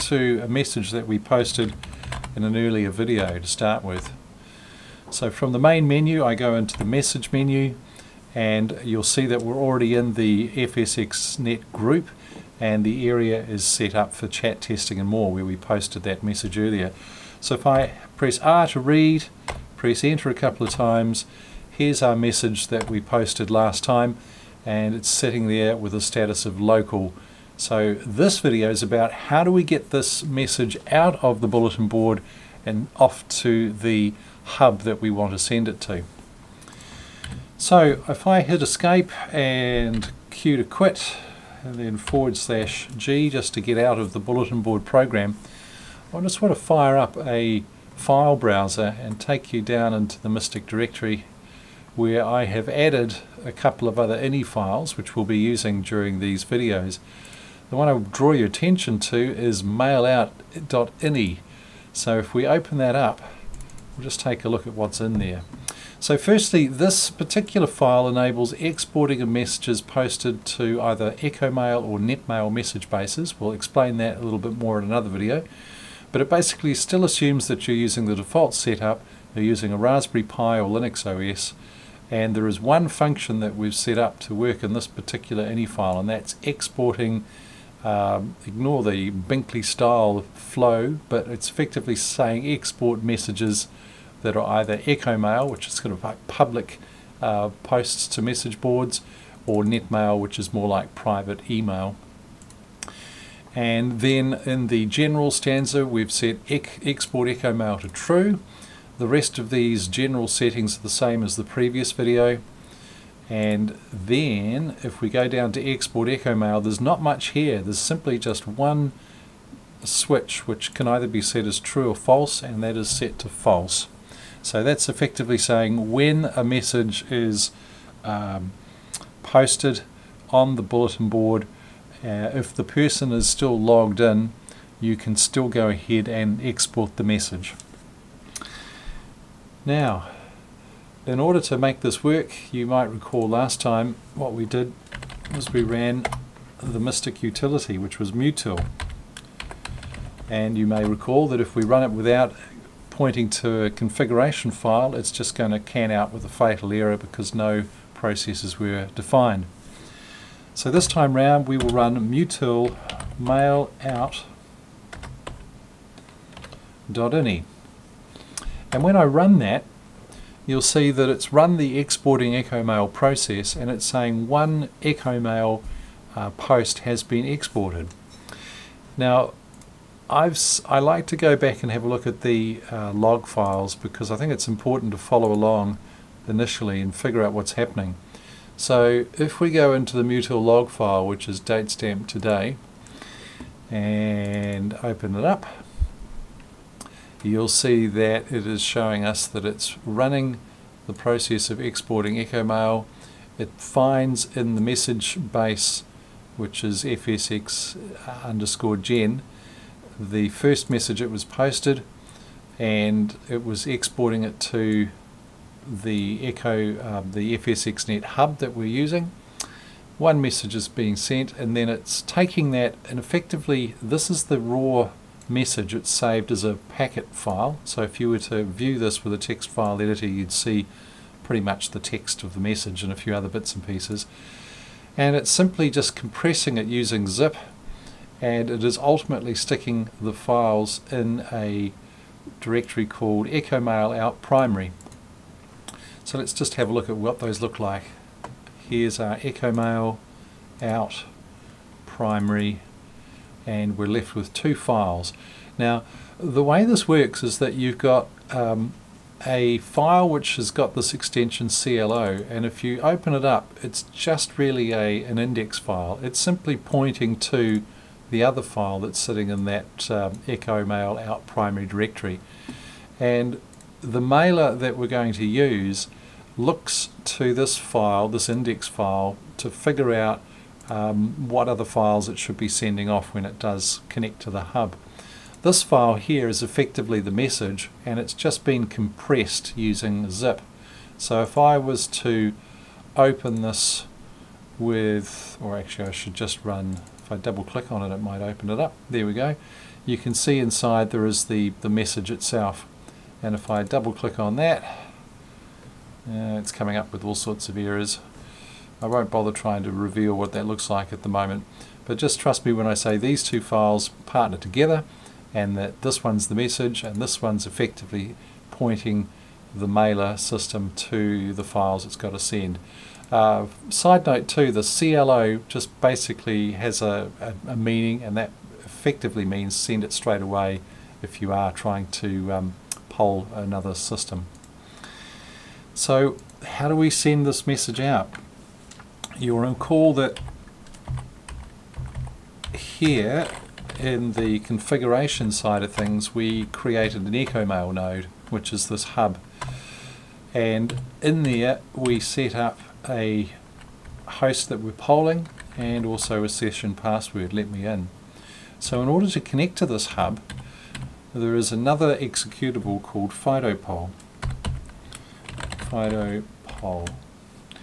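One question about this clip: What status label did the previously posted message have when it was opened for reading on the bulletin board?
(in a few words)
local.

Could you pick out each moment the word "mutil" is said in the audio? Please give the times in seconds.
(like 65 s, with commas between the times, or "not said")
148 s, 162 s, 190 s.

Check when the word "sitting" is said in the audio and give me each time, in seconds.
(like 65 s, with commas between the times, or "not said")
25 s, 268 s.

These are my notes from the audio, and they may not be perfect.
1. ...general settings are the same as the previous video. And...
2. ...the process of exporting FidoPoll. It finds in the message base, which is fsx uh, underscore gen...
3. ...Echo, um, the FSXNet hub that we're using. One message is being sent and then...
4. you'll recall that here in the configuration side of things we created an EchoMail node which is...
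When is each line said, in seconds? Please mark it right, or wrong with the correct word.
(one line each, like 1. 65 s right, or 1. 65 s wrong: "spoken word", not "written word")
1. 109 s right
2. 200 s wrong: "EchoMail", not "FidoPoll"
3. 216 s right
4. 339 s right.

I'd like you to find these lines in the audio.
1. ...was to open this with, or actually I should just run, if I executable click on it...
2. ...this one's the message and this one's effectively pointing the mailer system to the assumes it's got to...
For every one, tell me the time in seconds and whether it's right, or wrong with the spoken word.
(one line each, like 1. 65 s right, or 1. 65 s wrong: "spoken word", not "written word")
1. 291 s wrong: "double", not "executable"
2. 315 s wrong: "files", not "assumes".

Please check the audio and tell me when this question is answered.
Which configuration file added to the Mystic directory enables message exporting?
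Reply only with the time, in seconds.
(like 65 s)
59 s.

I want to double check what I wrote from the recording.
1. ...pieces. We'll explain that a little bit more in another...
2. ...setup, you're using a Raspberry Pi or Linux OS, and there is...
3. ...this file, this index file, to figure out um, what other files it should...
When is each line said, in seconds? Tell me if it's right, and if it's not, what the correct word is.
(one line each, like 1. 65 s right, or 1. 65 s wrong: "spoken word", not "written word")
1. 72 s wrong: "bases", not "pieces"
2. 78 s right
3. 277 s right.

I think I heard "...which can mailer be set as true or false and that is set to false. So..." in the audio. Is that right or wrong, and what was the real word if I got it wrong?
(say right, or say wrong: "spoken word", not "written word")
wrong: "either", not "mailer".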